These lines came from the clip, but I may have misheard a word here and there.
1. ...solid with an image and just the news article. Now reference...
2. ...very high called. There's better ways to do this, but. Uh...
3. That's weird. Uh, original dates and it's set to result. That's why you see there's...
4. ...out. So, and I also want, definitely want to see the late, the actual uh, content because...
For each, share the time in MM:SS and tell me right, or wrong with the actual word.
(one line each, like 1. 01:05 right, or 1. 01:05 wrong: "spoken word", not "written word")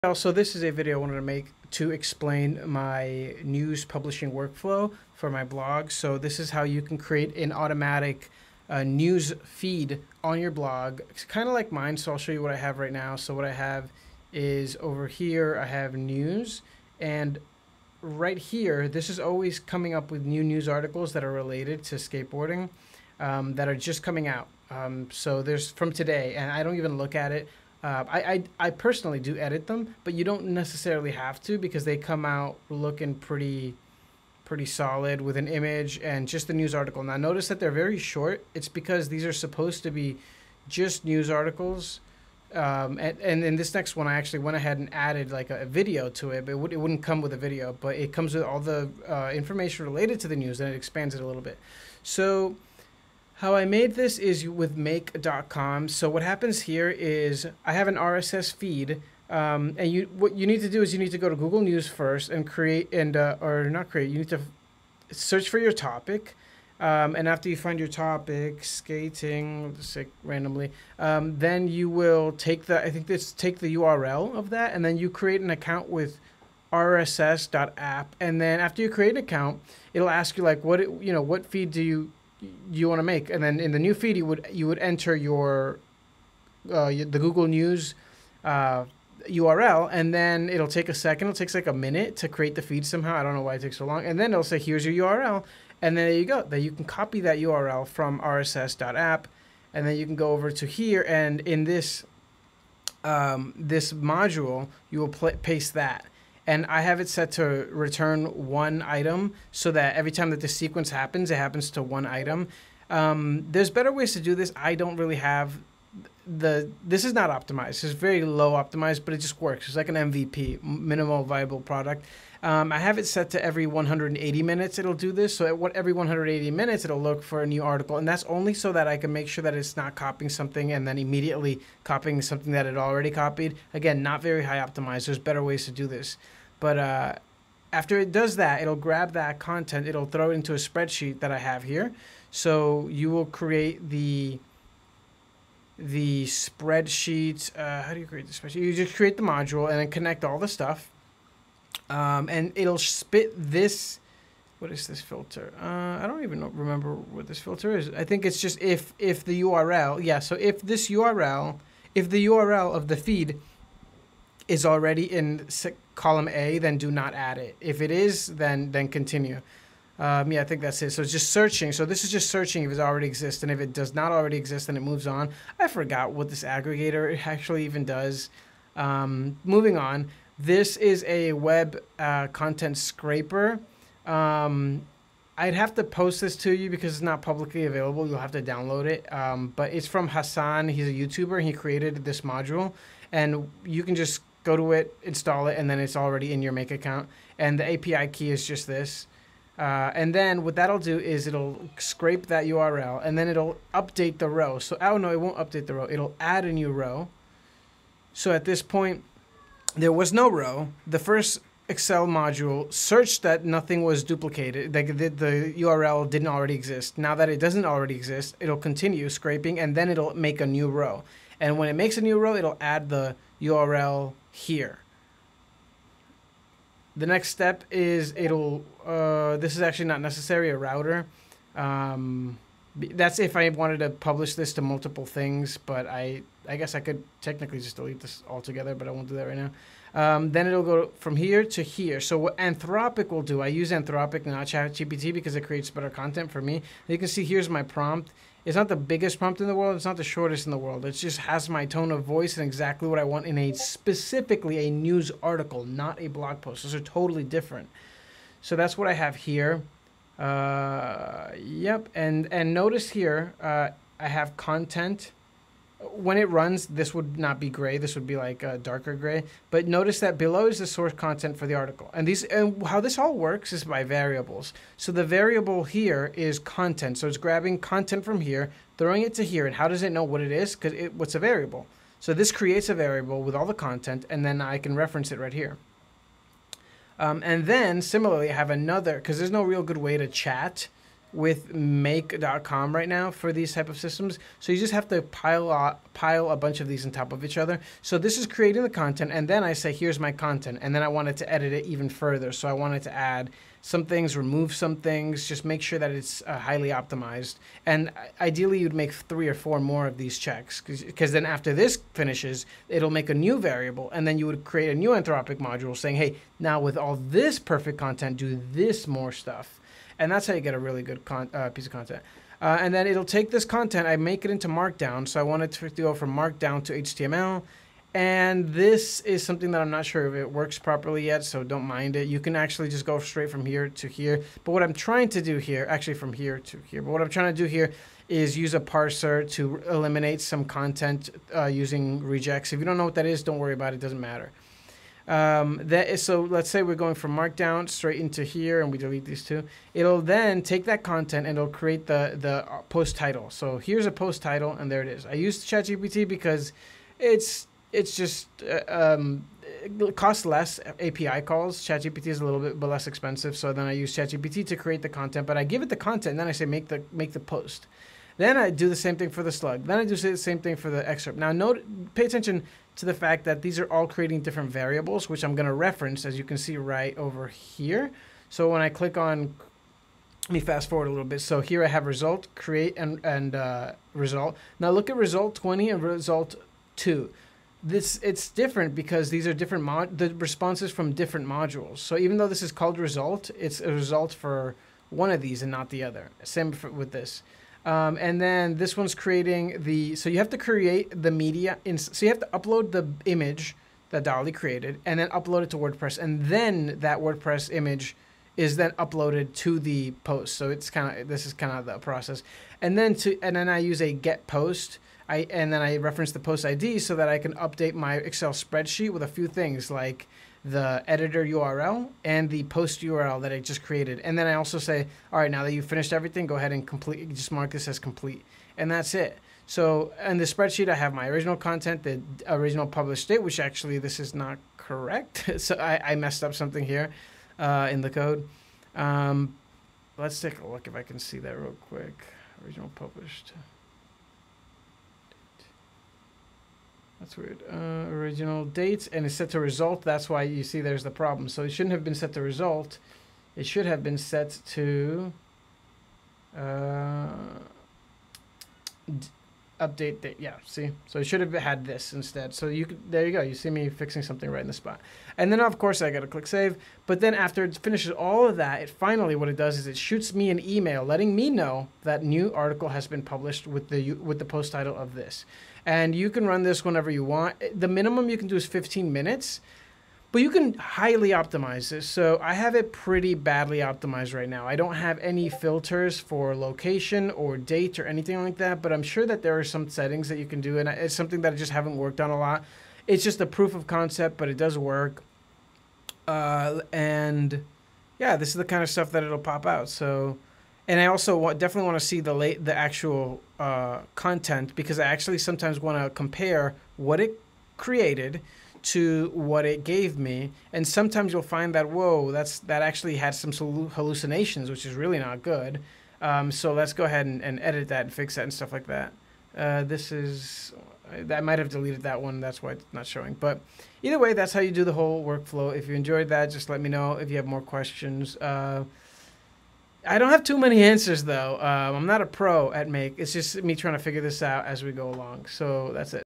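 1. 00:34 wrong: "notice", not "reference"
2. 02:14 wrong: "optimized", not "called"
3. 07:27 right
4. 08:19 right.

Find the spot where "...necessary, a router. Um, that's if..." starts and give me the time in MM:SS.
03:50.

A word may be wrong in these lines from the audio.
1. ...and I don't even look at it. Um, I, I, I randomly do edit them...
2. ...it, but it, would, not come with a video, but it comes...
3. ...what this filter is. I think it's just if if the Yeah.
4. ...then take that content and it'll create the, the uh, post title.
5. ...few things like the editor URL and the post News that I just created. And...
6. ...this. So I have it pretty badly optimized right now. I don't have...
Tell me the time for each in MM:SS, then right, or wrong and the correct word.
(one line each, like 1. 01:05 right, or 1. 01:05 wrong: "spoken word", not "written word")
1. 00:26 wrong: "personally", not "randomly"
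2. 00:46 right
3. 02:36 wrong: "URL", not "Yeah"
4. 05:50 right
5. 06:59 wrong: "URL", not "News"
6. 08:01 right.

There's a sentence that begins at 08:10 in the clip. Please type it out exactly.
And it's something that I just haven't worked on a lot.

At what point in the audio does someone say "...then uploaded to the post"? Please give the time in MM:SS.
06:48.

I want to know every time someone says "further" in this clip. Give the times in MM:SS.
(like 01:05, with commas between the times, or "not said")
05:01.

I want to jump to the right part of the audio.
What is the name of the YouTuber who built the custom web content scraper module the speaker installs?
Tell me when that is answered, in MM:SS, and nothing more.
03:10.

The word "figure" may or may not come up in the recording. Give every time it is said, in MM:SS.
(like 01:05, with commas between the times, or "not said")
08:53.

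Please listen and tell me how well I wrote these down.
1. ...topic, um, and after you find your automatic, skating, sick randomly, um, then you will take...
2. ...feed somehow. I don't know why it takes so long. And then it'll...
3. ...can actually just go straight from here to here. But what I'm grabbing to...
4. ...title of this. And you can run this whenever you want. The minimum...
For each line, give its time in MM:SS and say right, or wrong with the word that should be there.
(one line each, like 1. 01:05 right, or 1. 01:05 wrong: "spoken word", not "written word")
1. 01:05 wrong: "topic", not "automatic"
2. 01:32 right
3. 05:32 wrong: "trying", not "grabbing"
4. 07:54 right.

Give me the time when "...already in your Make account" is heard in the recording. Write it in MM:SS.
03:15.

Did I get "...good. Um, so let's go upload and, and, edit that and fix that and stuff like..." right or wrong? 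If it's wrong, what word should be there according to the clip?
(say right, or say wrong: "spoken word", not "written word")
wrong: "ahead", not "upload".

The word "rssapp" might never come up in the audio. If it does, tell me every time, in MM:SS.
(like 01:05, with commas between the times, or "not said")
01:16, 01:38.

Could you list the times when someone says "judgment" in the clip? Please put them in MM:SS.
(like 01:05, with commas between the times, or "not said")
not said.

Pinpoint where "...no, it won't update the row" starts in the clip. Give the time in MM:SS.
03:24.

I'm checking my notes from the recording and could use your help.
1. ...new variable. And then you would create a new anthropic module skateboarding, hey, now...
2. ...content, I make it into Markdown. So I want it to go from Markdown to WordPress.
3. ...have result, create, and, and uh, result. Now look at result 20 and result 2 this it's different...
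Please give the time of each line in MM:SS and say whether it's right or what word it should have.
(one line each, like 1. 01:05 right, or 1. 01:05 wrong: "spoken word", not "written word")
1. 05:13 wrong: "saying", not "skateboarding"
2. 05:23 wrong: "HTML", not "WordPress"
3. 06:21 right.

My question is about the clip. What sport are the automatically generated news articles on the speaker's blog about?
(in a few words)
skateboarding.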